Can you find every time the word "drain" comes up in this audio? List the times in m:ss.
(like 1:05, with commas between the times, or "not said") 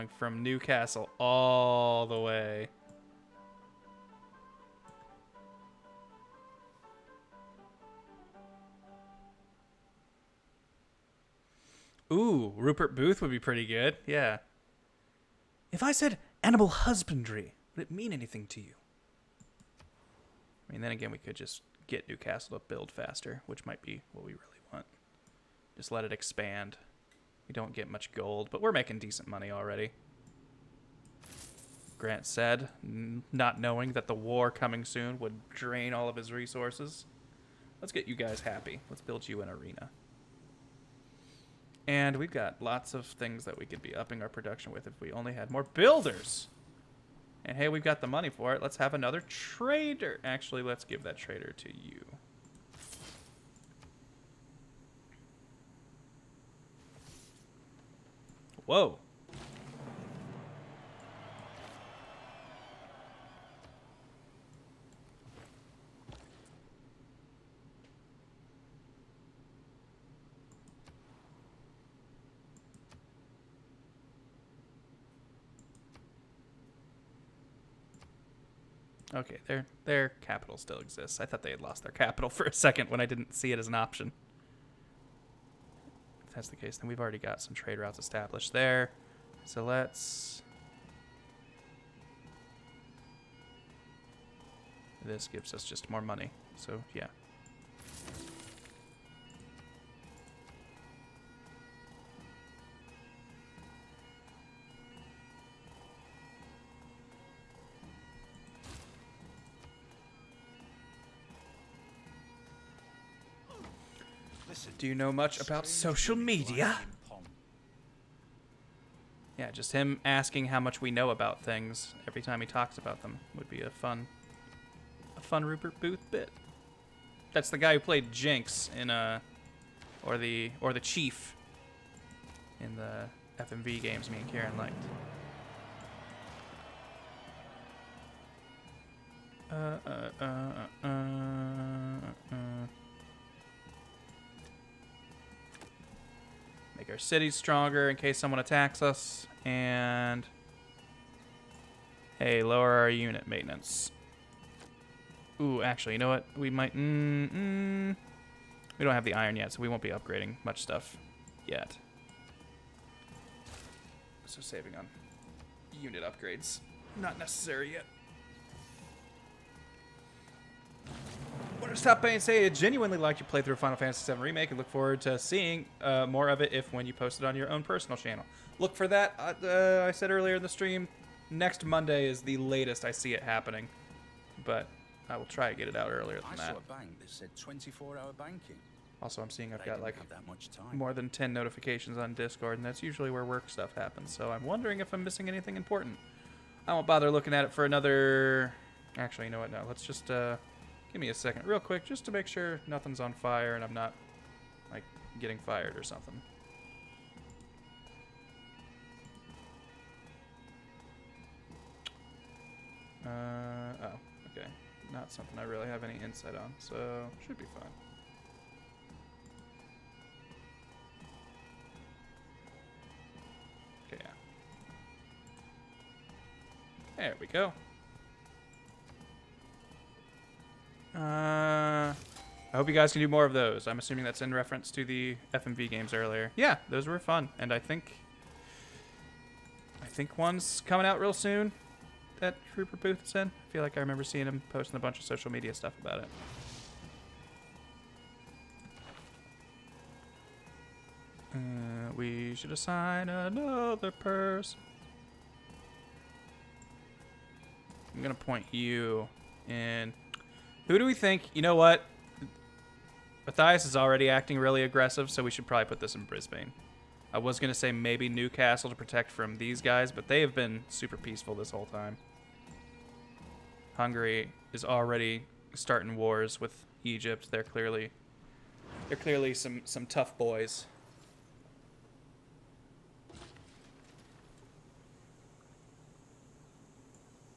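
0:35.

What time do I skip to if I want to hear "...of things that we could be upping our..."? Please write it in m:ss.
0:42.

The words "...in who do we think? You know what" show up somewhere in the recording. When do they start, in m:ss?
4:19.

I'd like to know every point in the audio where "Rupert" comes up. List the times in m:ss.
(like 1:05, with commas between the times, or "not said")
0:12, 2:05, 4:02.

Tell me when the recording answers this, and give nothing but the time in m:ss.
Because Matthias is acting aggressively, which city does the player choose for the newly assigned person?
4:26.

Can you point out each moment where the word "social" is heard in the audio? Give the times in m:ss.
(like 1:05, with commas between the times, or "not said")
1:55, 4:05.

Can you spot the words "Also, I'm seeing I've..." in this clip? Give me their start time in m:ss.
3:09.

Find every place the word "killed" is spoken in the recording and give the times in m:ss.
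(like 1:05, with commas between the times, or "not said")
not said.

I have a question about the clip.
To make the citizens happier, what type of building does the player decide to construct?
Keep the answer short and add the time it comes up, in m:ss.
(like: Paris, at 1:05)
Arena, at 0:39.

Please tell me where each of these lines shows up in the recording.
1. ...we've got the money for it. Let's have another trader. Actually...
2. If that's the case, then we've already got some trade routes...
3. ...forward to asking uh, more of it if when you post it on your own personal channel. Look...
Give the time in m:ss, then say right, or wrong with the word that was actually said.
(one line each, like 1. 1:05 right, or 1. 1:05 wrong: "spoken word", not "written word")
1. 0:47 right
2. 1:26 right
3. 2:54 wrong: "seeing", not "asking".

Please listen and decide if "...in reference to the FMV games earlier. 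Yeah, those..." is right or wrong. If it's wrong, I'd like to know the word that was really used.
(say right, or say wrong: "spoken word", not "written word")
right.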